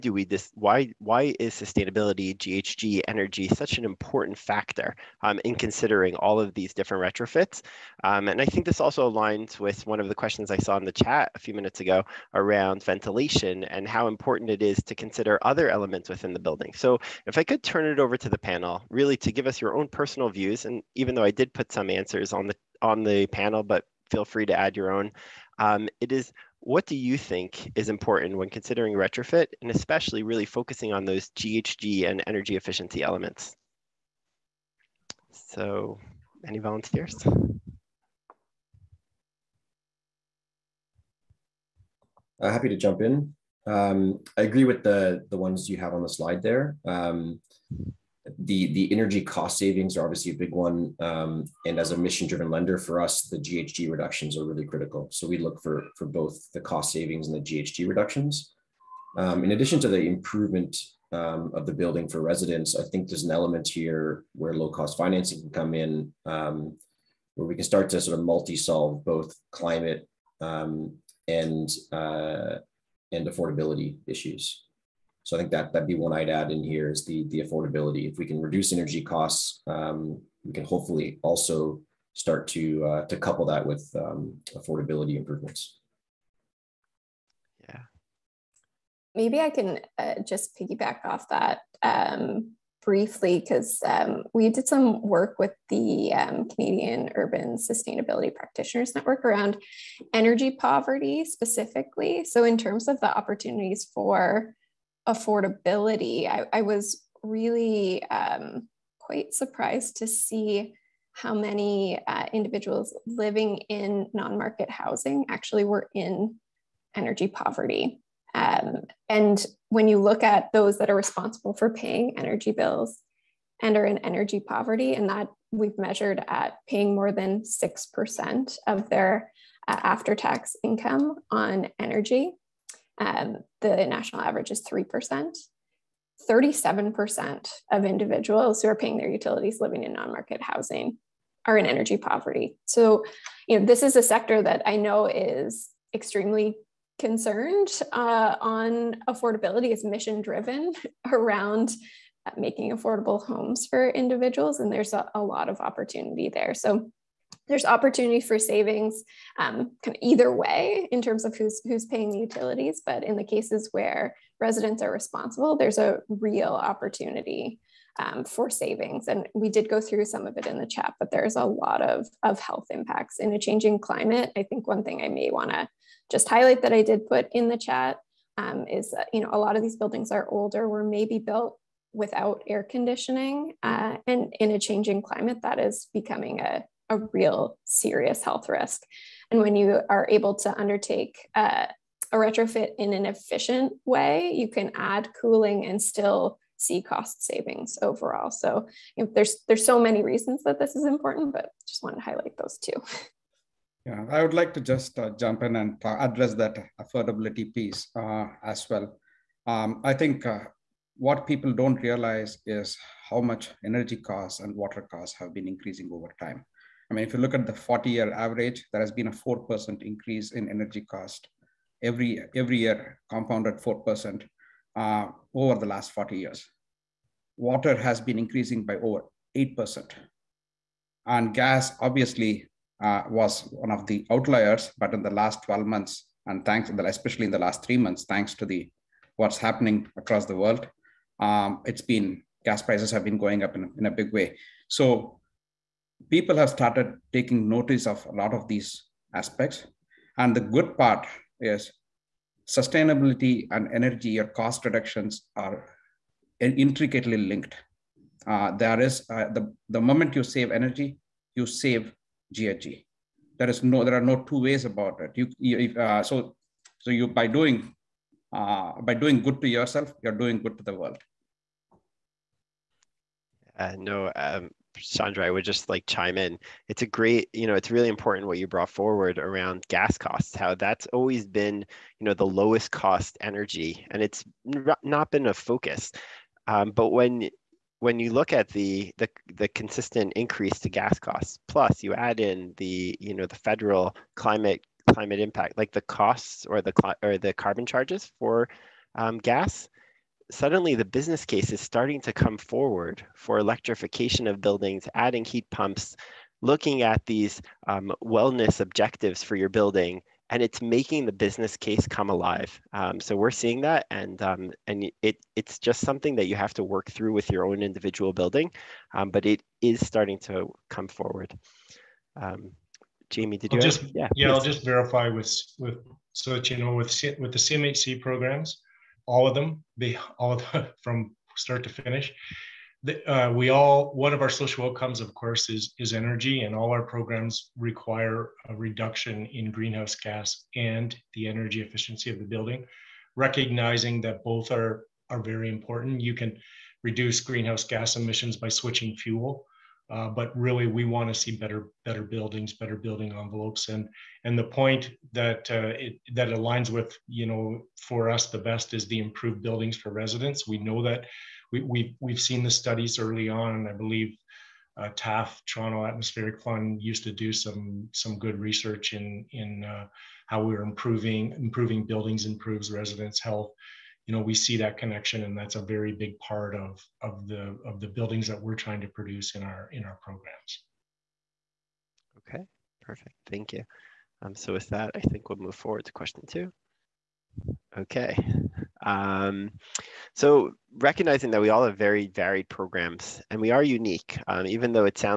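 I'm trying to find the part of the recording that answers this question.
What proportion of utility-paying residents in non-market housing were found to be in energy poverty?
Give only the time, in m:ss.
2:16.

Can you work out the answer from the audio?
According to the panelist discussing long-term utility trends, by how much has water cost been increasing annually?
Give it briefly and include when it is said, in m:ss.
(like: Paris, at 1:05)
over 8%, at 3:48.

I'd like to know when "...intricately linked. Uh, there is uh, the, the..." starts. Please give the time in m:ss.
4:16.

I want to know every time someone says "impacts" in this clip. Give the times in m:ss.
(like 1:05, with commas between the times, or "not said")
2:52, 4:55.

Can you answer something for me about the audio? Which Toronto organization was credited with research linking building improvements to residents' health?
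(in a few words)
Toronto Atmospheric Fund.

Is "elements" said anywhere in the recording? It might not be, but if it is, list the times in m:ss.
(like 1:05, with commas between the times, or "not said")
0:15, 0:33, 1:03.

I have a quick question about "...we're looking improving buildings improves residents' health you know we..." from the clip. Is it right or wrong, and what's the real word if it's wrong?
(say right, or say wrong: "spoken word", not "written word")
wrong: "improving", not "looking".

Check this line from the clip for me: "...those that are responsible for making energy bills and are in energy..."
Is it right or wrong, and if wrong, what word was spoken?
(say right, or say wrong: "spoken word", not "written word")
wrong: "paying", not "making".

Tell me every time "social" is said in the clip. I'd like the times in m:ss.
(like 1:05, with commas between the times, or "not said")
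5:34.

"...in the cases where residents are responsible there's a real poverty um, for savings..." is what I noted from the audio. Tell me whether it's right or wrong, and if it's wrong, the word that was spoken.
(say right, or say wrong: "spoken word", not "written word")
wrong: "opportunity", not "poverty".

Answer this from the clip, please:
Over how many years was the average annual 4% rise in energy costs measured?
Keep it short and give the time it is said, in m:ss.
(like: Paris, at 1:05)
40 years, at 3:37.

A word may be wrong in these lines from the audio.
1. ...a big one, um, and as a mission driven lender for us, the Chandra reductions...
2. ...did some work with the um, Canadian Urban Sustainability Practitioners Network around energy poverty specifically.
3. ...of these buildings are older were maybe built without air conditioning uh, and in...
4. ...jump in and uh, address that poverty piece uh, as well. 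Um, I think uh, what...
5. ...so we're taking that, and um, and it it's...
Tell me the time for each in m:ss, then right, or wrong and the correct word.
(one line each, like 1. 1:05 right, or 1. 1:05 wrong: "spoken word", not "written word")
1. 0:50 wrong: "GHG", not "Chandra"
2. 1:34 right
3. 2:59 right
4. 3:25 wrong: "affordability", not "poverty"
5. 5:12 wrong: "seeing", not "taking".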